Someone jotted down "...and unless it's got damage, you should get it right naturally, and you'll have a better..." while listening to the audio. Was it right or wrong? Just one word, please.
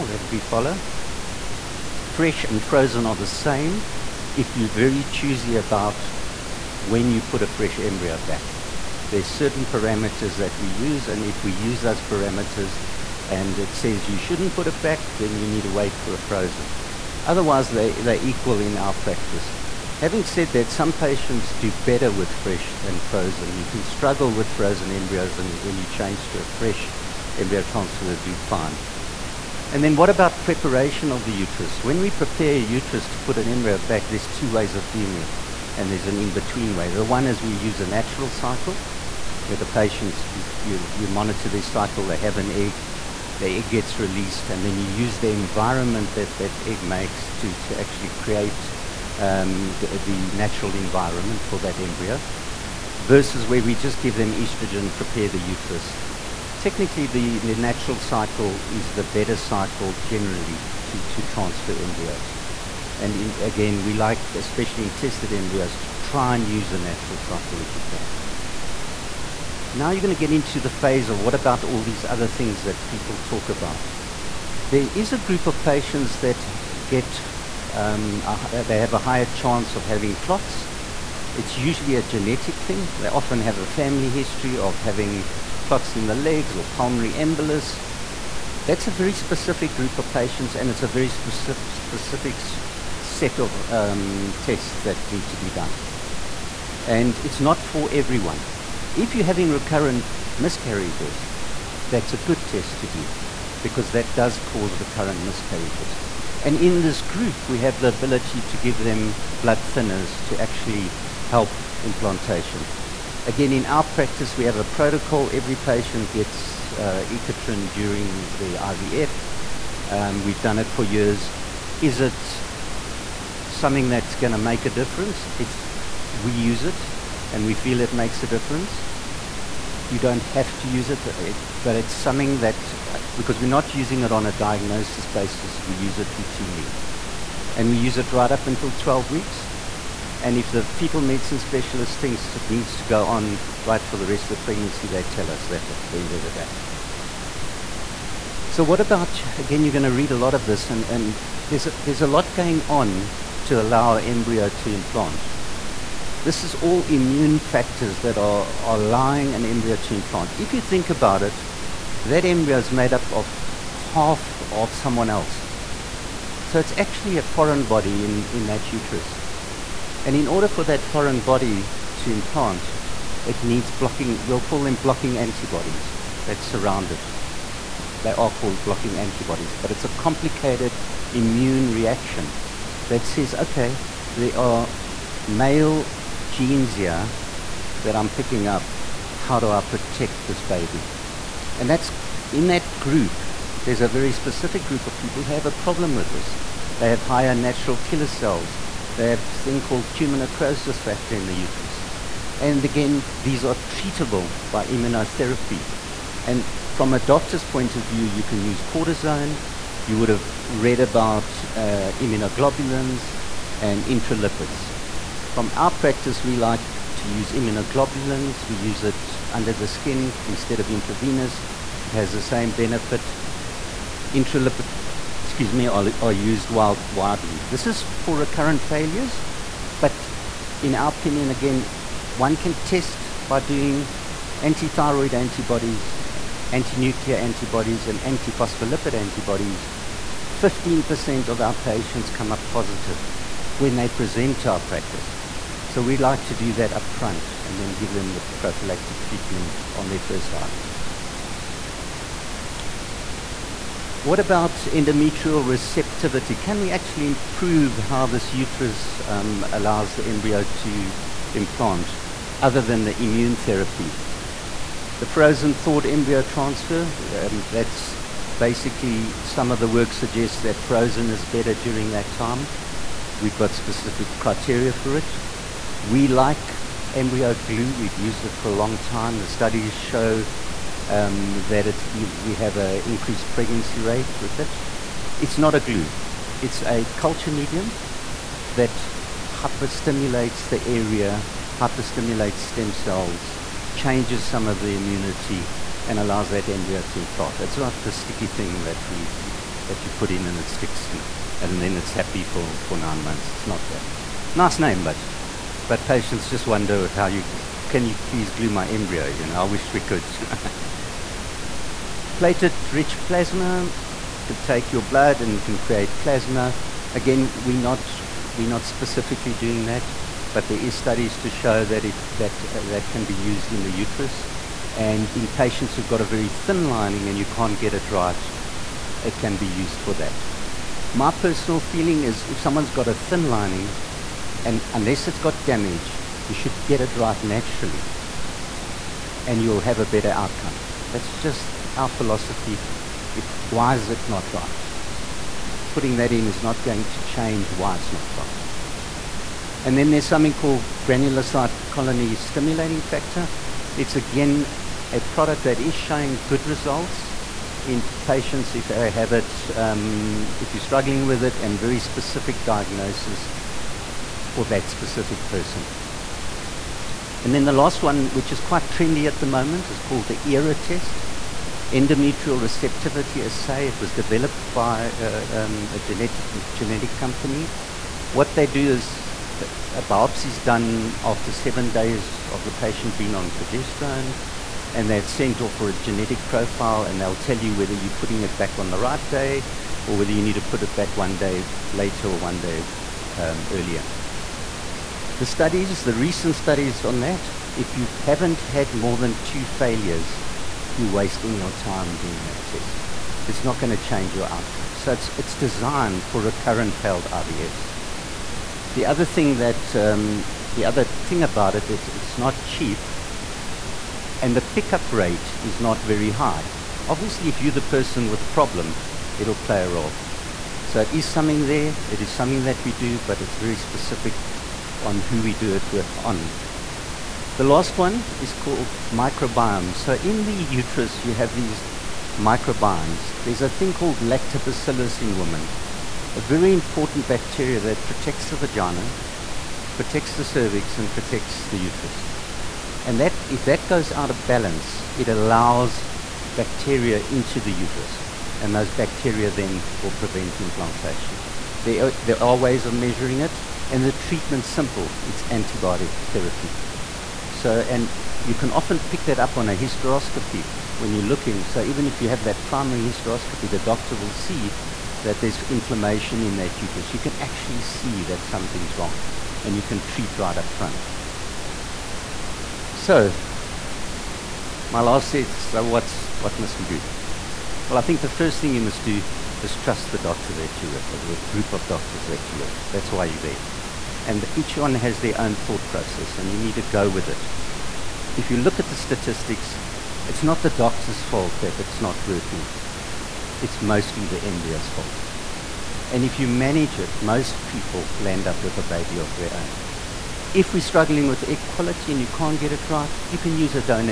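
right.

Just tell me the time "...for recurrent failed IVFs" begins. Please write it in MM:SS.
06:46.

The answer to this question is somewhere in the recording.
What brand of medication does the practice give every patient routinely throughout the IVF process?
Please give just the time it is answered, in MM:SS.
01:57.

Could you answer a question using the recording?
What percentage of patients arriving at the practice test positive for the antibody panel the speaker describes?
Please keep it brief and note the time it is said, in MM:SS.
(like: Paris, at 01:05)
15%, at 04:00.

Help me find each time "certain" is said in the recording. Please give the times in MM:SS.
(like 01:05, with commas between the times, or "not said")
00:09.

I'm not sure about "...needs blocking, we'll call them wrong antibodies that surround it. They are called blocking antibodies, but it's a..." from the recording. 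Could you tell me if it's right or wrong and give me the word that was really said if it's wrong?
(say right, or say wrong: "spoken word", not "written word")
wrong: "blocking", not "wrong".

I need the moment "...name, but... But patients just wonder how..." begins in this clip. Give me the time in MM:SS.
05:04.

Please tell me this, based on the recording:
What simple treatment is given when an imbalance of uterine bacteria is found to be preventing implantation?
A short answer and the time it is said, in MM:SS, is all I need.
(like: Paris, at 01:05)
antibiotic therapy, at 07:35.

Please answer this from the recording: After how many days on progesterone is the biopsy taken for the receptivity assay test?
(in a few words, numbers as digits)
7 days.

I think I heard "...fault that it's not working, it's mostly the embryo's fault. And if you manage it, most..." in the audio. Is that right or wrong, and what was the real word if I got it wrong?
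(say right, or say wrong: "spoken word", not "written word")
right.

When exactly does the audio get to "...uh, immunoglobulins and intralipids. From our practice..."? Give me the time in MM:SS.
03:31.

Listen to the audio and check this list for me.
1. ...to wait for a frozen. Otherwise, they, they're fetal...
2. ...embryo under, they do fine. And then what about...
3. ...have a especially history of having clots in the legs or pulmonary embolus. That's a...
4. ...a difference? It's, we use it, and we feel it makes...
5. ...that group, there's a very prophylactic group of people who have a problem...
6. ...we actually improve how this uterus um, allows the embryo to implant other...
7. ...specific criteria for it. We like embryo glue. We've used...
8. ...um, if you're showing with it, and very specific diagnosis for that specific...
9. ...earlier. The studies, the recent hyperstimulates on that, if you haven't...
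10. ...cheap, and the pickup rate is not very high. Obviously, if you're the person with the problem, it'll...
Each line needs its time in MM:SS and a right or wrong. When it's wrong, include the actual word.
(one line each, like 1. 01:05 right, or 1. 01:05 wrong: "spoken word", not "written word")
1. 00:15 wrong: "equal", not "fetal"
2. 00:27 wrong: "transfer", not "under"
3. 01:23 wrong: "family", not "especially"
4. 02:04 right
5. 03:12 wrong: "specific", not "prophylactic"
6. 04:16 right
7. 04:33 right
8. 05:59 wrong: "struggling", not "showing"
9. 06:33 wrong: "studies", not "hyperstimulates"
10. 06:52 right.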